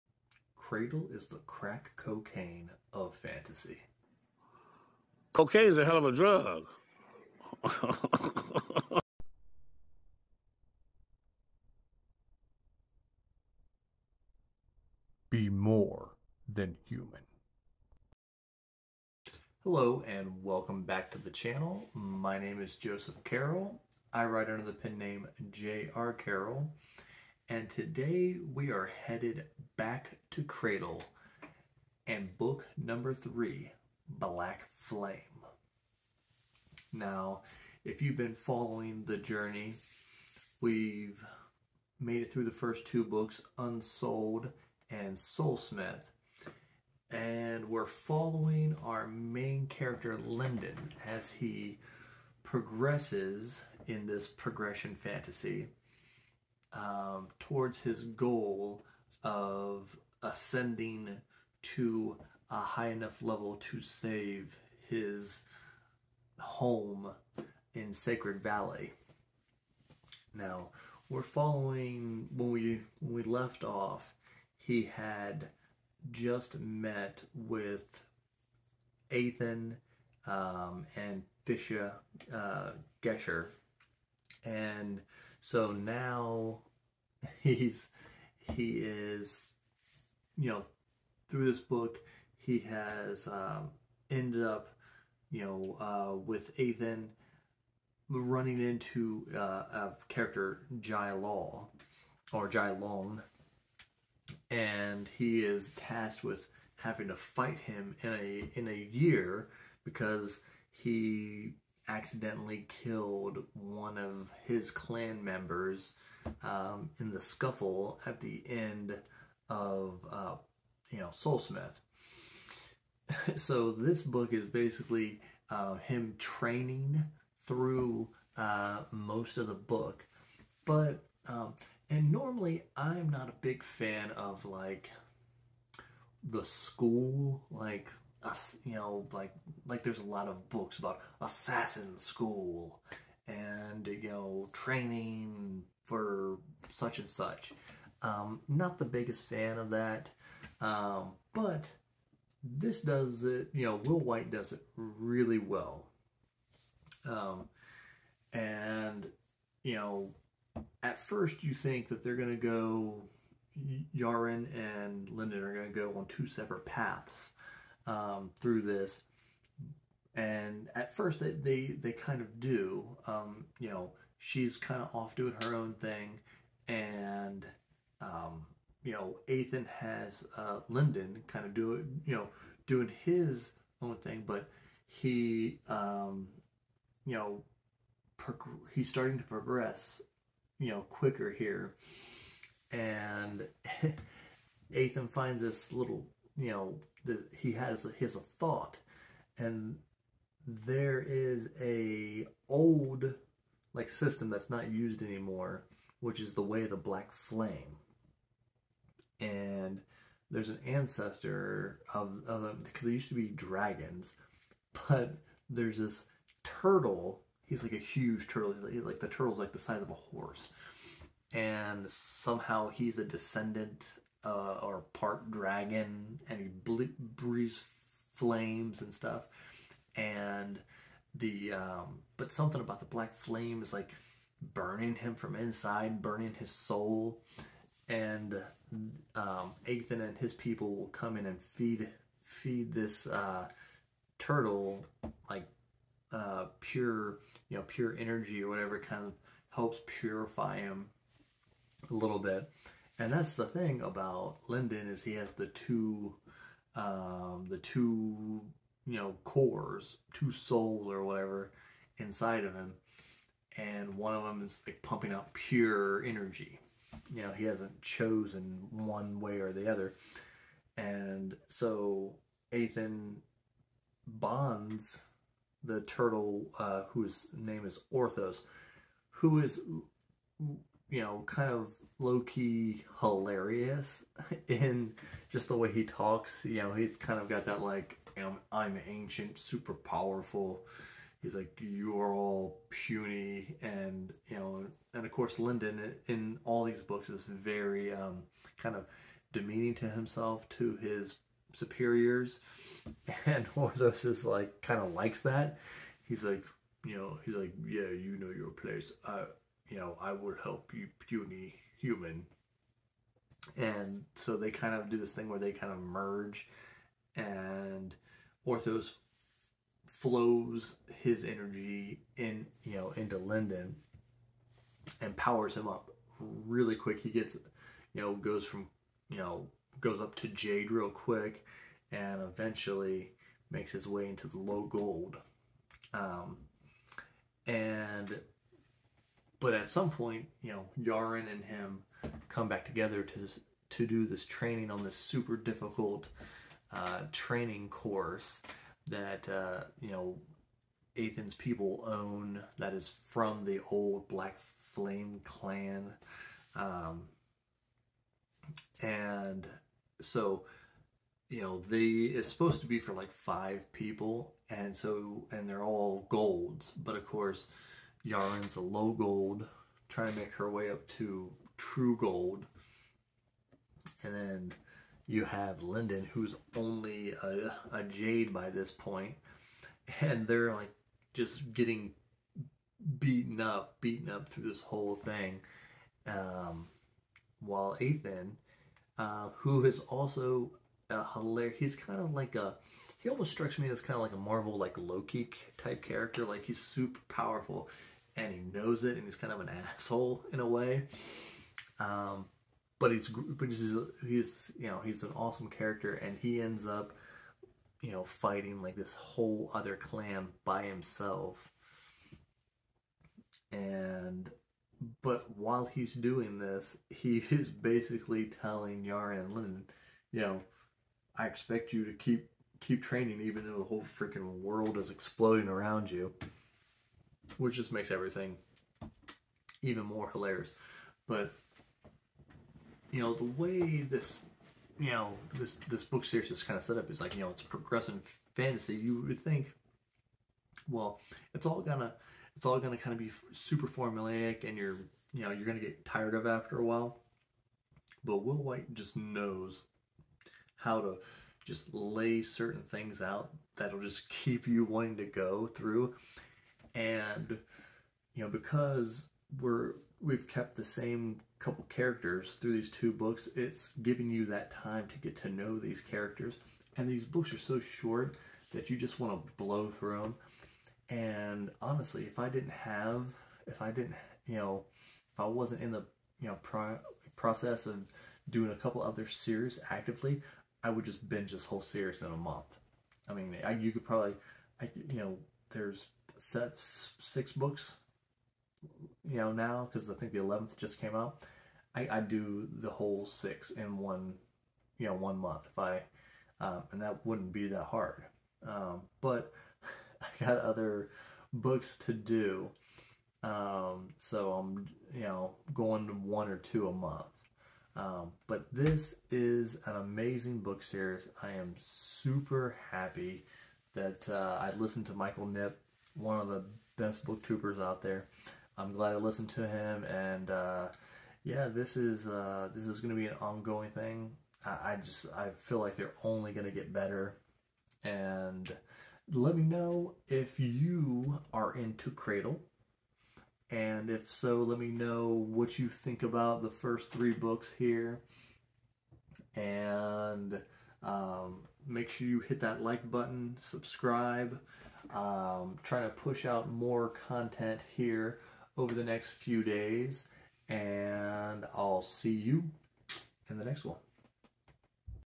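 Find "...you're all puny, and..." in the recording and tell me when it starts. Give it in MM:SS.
04:51.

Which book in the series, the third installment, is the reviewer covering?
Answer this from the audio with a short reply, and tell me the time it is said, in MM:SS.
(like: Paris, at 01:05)
Blackflame, at 00:34.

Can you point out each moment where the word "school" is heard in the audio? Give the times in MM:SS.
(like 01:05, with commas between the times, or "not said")
02:16, 02:21.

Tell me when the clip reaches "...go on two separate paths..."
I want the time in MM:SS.
02:45.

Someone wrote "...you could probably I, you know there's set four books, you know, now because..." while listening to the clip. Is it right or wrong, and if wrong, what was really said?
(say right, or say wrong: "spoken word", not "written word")
wrong: "six", not "four".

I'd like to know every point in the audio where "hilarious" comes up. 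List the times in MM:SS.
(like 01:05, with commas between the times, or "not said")
04:42, 06:31, 07:10.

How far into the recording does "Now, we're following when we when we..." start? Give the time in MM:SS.
01:10.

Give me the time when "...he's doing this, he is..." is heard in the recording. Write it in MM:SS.
06:55.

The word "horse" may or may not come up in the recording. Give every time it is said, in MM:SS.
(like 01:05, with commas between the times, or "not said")
03:39.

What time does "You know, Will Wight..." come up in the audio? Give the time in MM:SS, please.
02:33.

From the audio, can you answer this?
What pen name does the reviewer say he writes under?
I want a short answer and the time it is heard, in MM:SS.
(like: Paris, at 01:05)
J.R. Carrel, at 00:25.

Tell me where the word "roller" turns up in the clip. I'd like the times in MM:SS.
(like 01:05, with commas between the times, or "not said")
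not said.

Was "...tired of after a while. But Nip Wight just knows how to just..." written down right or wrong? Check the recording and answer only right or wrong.
wrong.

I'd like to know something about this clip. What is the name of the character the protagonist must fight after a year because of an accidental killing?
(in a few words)
Jai Long.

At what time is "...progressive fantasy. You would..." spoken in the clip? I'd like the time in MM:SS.
07:17.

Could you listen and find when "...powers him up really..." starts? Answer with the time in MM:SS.
05:25.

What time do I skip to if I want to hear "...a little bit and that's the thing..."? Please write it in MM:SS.
04:11.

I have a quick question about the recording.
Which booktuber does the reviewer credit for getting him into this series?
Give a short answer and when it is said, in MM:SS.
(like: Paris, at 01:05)
Michael Nip, at 08:34.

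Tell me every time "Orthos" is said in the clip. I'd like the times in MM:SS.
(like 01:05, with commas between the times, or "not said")
04:37, 05:03, 05:18.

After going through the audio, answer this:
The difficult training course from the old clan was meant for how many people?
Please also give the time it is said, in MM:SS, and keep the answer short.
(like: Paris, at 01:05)
5, at 06:03.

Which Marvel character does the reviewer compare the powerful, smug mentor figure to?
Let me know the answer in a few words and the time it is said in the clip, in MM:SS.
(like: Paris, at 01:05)
Loki, at 06:34.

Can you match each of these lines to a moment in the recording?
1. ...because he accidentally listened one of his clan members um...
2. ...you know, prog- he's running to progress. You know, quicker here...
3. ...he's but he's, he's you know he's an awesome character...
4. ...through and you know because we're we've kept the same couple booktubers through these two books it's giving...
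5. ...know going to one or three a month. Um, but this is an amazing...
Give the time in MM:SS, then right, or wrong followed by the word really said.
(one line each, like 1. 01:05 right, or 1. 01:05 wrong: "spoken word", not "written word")
1. 01:49 wrong: "killed", not "listened"
2. 03:07 wrong: "starting", not "running"
3. 06:42 right
4. 07:35 wrong: "characters", not "booktubers"
5. 08:25 wrong: "two", not "three".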